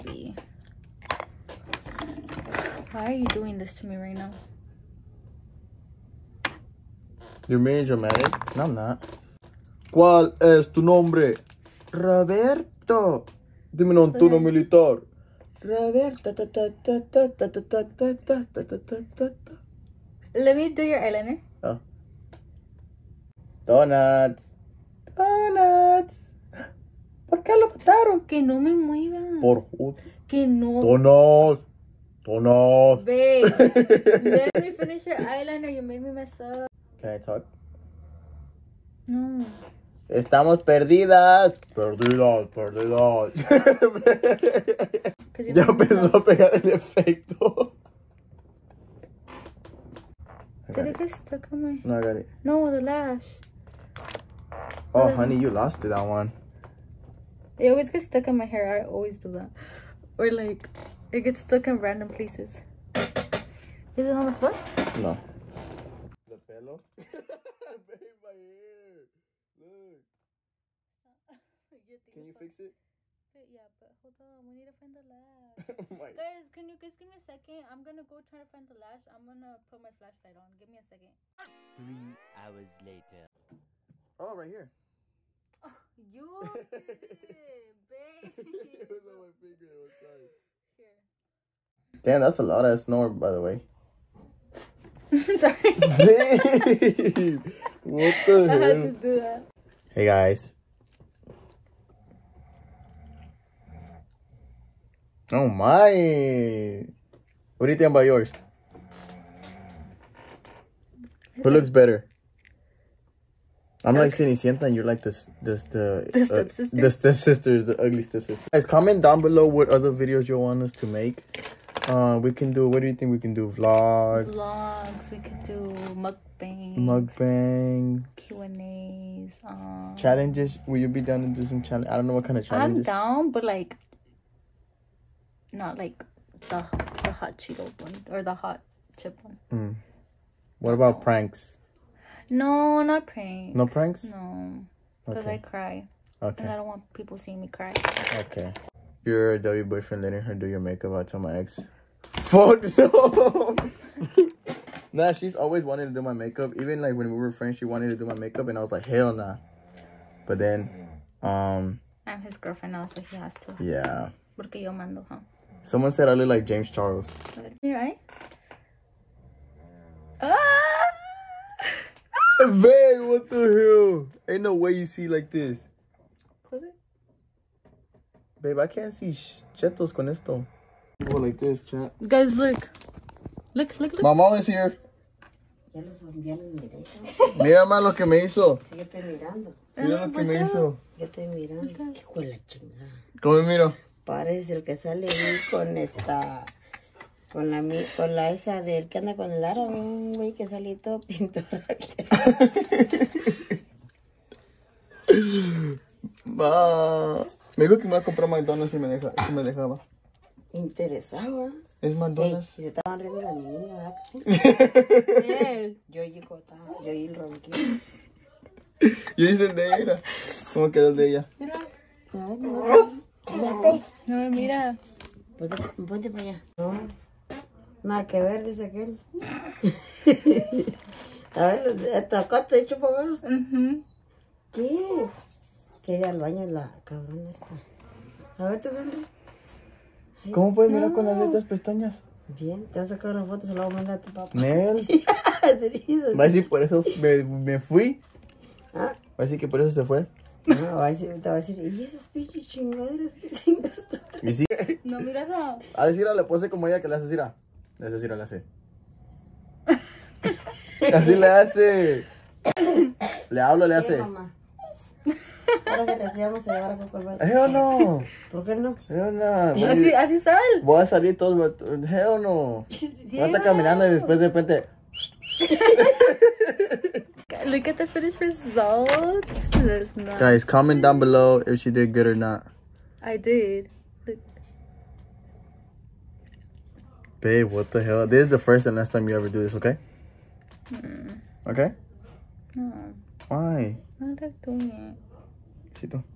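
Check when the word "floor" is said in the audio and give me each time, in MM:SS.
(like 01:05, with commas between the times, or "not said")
01:04.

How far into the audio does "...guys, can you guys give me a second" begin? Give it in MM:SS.
01:16.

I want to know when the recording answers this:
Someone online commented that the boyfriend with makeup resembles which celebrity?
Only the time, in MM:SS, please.
02:46.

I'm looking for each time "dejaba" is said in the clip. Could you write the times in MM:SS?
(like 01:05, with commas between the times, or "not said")
03:29.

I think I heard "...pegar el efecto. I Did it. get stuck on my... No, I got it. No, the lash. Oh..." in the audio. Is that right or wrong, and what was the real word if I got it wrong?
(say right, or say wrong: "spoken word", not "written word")
right.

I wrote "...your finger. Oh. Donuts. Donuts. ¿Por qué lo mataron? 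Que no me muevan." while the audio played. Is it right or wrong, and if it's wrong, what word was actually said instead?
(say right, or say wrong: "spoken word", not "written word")
wrong: "eyeliner", not "finger".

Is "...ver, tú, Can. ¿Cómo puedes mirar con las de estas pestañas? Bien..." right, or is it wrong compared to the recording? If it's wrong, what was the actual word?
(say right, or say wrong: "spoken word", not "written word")
wrong: "Henry", not "Can".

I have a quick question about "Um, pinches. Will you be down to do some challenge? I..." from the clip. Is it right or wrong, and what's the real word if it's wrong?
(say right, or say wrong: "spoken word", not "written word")
wrong: "challenges", not "pinches".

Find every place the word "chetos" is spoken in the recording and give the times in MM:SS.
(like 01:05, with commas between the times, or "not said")
02:59.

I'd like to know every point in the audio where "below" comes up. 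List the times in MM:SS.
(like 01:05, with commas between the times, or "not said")
01:59, 04:41.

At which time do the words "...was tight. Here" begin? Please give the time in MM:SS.
01:29.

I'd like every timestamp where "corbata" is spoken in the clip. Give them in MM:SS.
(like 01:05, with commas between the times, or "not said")
04:26.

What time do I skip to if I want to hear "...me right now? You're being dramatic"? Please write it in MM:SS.
00:03.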